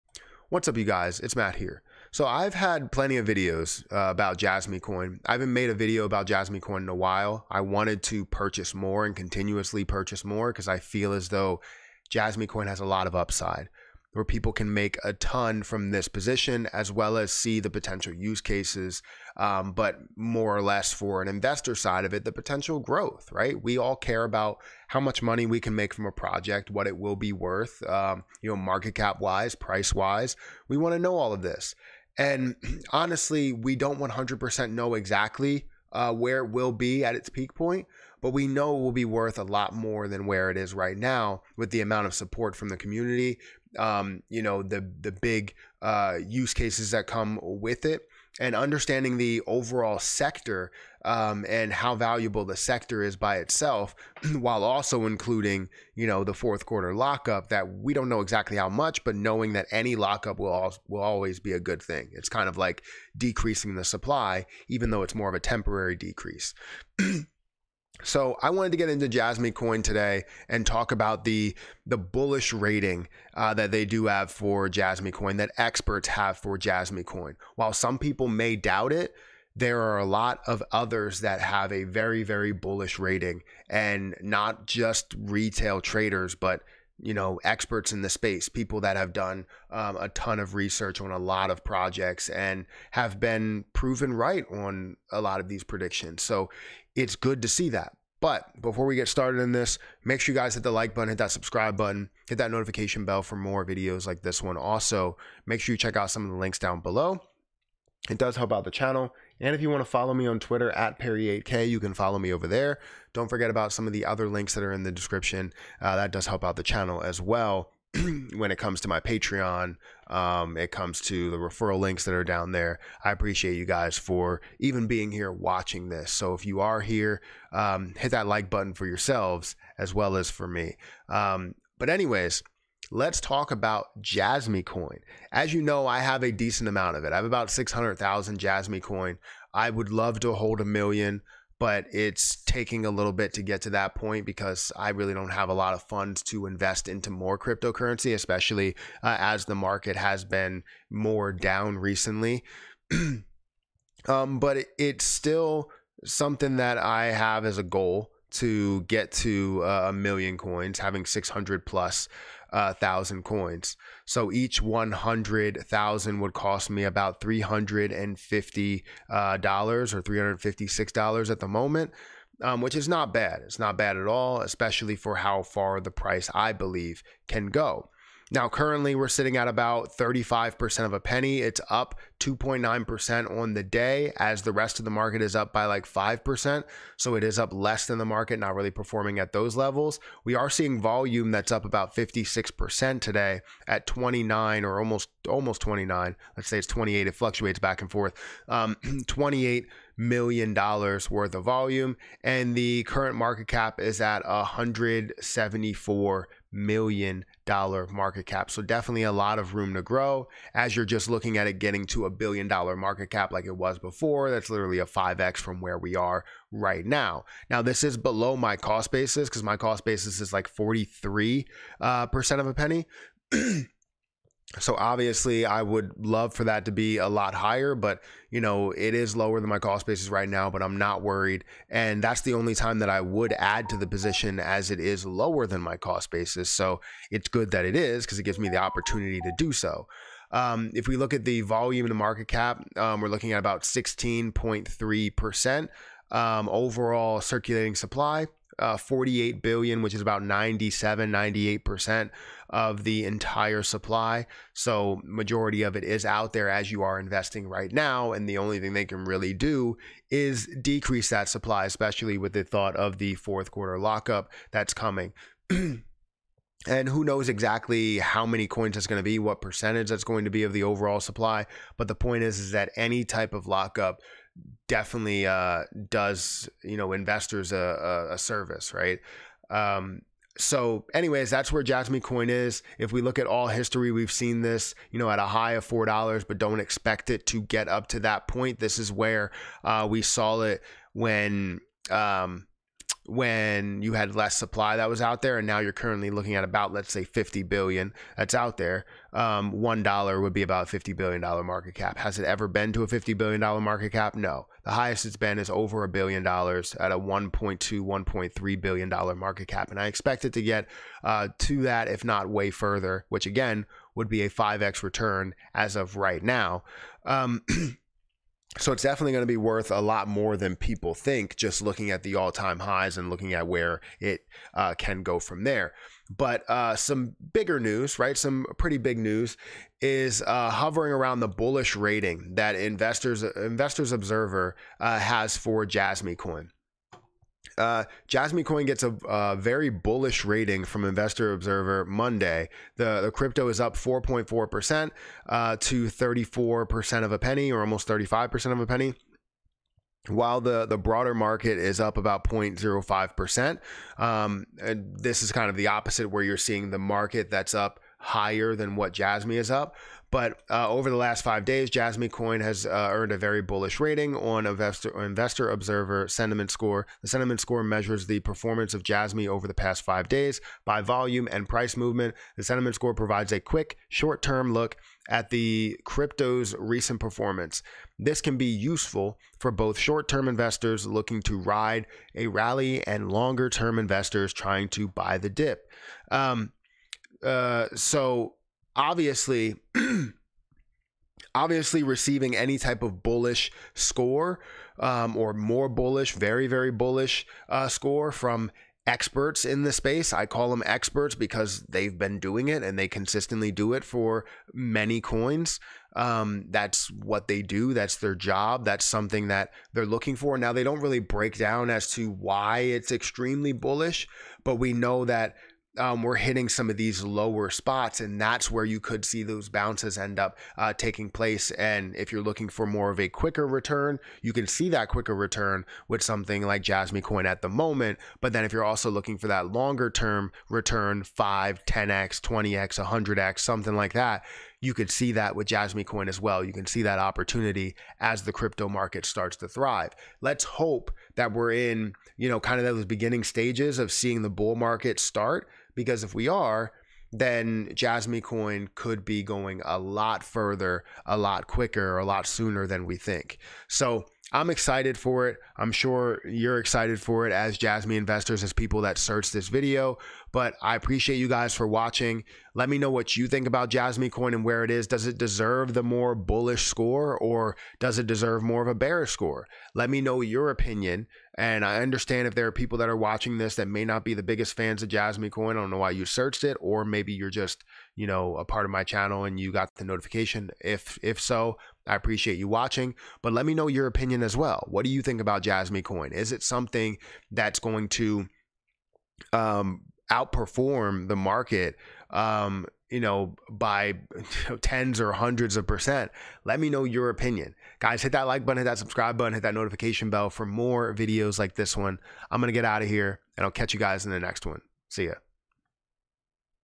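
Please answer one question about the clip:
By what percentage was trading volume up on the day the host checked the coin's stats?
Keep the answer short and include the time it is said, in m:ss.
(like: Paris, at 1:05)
56%, at 3:11.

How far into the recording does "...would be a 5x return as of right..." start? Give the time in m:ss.
5:13.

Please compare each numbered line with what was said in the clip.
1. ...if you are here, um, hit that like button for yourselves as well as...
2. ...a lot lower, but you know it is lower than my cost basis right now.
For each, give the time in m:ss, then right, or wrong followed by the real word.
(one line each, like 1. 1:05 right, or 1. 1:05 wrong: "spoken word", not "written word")
1. 2:06 right
2. 3:46 wrong: "higher", not "lower".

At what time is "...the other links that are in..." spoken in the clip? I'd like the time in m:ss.
1:53.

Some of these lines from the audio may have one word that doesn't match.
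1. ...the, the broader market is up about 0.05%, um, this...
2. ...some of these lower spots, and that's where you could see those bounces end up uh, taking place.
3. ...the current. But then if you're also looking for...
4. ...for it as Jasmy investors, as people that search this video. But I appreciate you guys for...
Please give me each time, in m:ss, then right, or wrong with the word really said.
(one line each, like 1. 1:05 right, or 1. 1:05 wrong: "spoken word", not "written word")
1. 5:50 right
2. 6:56 right
3. 7:07 wrong: "moment", not "current"
4. 7:37 right.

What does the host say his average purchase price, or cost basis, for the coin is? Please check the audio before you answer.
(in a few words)
43% of a penny.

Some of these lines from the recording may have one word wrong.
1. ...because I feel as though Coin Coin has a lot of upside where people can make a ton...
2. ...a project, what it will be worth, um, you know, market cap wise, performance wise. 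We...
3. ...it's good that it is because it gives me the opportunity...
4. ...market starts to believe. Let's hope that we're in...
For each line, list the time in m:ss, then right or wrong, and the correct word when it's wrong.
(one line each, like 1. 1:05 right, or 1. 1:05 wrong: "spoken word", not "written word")
1. 0:10 wrong: "Jasmy", not "Coin"
2. 0:26 wrong: "price", not "performance"
3. 3:57 right
4. 7:18 wrong: "thrive", not "believe".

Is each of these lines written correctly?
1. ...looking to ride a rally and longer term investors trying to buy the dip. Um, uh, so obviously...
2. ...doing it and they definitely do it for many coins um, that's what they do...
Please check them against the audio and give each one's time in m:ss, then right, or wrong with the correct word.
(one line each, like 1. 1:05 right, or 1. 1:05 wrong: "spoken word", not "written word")
1. 6:20 right
2. 6:42 wrong: "consistently", not "definitely".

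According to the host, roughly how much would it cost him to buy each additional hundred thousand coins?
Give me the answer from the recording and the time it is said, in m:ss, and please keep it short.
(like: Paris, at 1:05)
$356, at 2:50.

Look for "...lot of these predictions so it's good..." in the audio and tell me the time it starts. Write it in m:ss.
1:35.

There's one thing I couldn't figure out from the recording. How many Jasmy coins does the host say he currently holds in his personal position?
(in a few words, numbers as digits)
600,000.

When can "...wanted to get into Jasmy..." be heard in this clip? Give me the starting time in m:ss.
1:08.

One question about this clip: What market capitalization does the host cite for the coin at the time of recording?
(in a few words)
$174 million.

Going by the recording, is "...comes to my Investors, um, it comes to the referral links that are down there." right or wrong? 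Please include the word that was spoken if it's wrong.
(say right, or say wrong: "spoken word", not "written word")
wrong: "Patreon", not "Investors".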